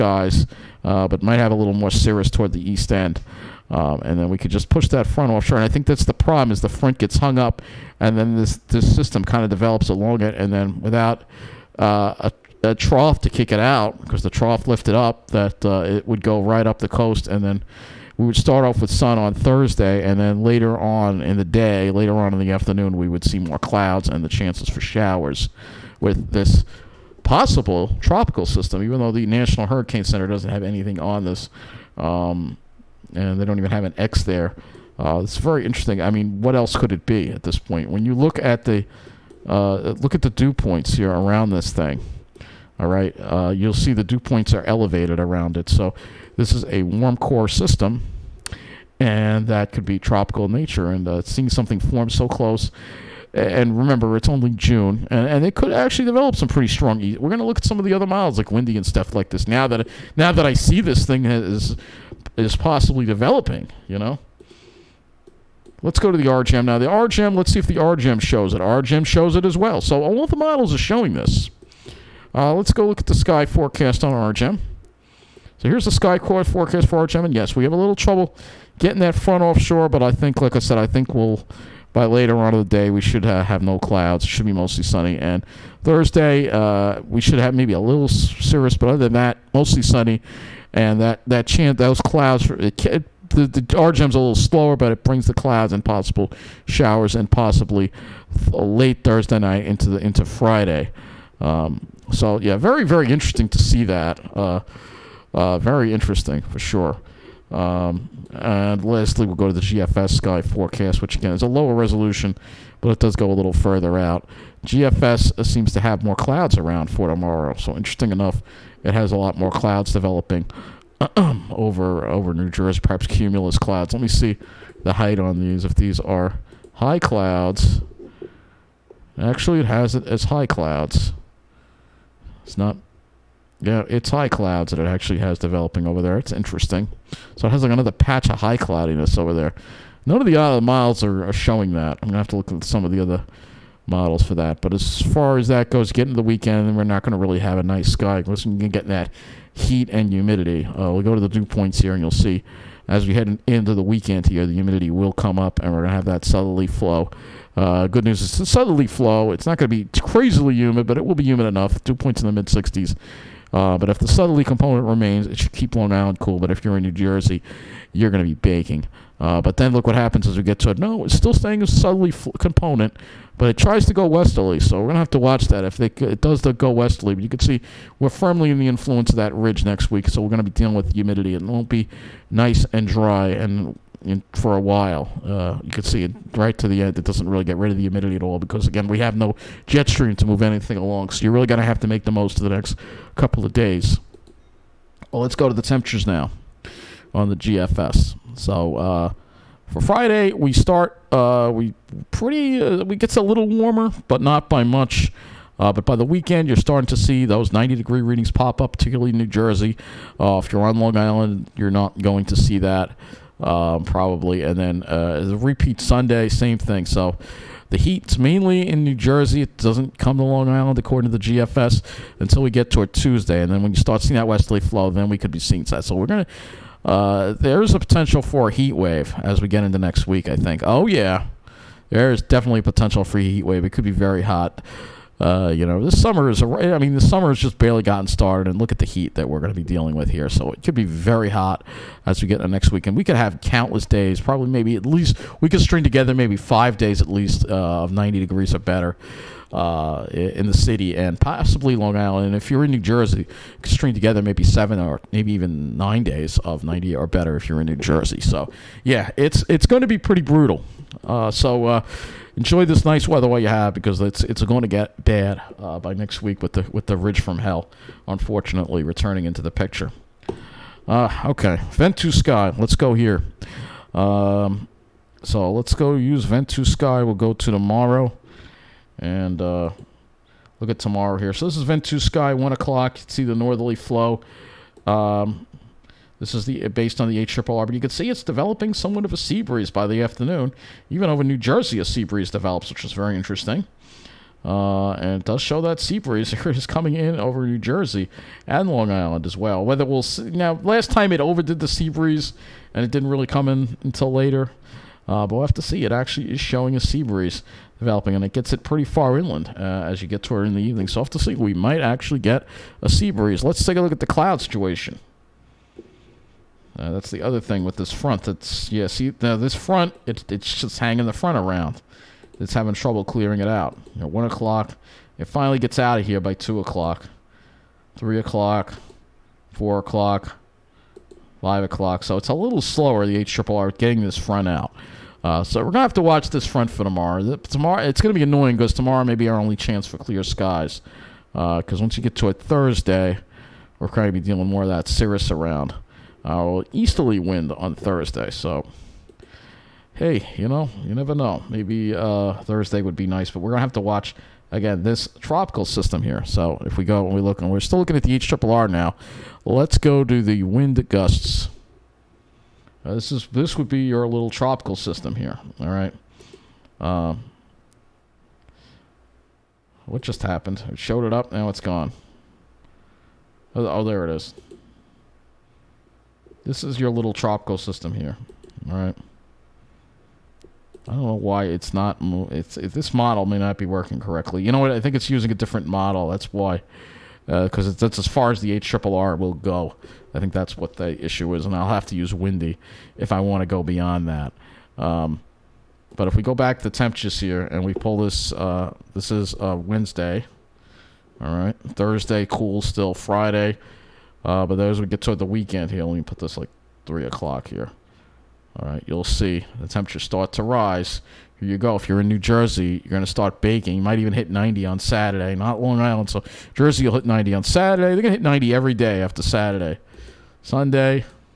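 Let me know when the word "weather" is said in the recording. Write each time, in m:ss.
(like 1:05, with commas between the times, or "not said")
4:23.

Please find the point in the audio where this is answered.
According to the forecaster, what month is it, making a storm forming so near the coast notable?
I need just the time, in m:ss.
0:54.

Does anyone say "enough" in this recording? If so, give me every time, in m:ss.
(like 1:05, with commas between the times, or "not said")
1:58, 2:41.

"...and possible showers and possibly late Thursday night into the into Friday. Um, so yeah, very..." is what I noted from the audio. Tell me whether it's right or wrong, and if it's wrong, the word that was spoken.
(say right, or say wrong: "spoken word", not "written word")
right.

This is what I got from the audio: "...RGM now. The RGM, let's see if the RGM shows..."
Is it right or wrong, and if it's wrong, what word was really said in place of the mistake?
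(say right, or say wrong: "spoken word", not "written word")
right.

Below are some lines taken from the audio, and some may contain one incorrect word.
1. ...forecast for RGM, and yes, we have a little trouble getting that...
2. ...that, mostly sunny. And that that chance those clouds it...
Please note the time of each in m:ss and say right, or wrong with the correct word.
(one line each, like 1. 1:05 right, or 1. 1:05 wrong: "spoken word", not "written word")
1. 1:16 right
2. 1:29 right.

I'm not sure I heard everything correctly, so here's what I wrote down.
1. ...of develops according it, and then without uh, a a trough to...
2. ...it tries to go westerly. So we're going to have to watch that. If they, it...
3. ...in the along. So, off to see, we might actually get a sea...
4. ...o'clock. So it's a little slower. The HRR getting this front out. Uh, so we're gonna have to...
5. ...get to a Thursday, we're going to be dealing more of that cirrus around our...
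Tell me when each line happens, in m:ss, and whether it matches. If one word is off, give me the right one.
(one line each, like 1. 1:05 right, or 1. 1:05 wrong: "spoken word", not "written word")
1. 0:09 wrong: "along", not "according"
2. 2:53 right
3. 5:10 wrong: "evening", not "along"
4. 5:31 right
5. 5:42 right.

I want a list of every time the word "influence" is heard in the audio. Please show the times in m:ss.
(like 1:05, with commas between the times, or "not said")
2:58.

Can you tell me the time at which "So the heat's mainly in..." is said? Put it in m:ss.
3:36.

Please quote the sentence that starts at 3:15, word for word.
Well, let's go to the temperatures now on the GFS.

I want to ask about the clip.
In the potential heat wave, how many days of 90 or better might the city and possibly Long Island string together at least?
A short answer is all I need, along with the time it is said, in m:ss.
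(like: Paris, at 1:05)
5, at 4:06.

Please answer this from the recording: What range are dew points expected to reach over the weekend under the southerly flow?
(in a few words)
mid 60s.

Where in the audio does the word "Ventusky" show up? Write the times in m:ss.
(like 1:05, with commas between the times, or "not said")
4:31, 4:36, 4:41.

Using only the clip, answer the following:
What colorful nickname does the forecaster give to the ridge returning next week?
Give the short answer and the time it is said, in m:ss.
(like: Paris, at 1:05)
ridge from hell, at 4:26.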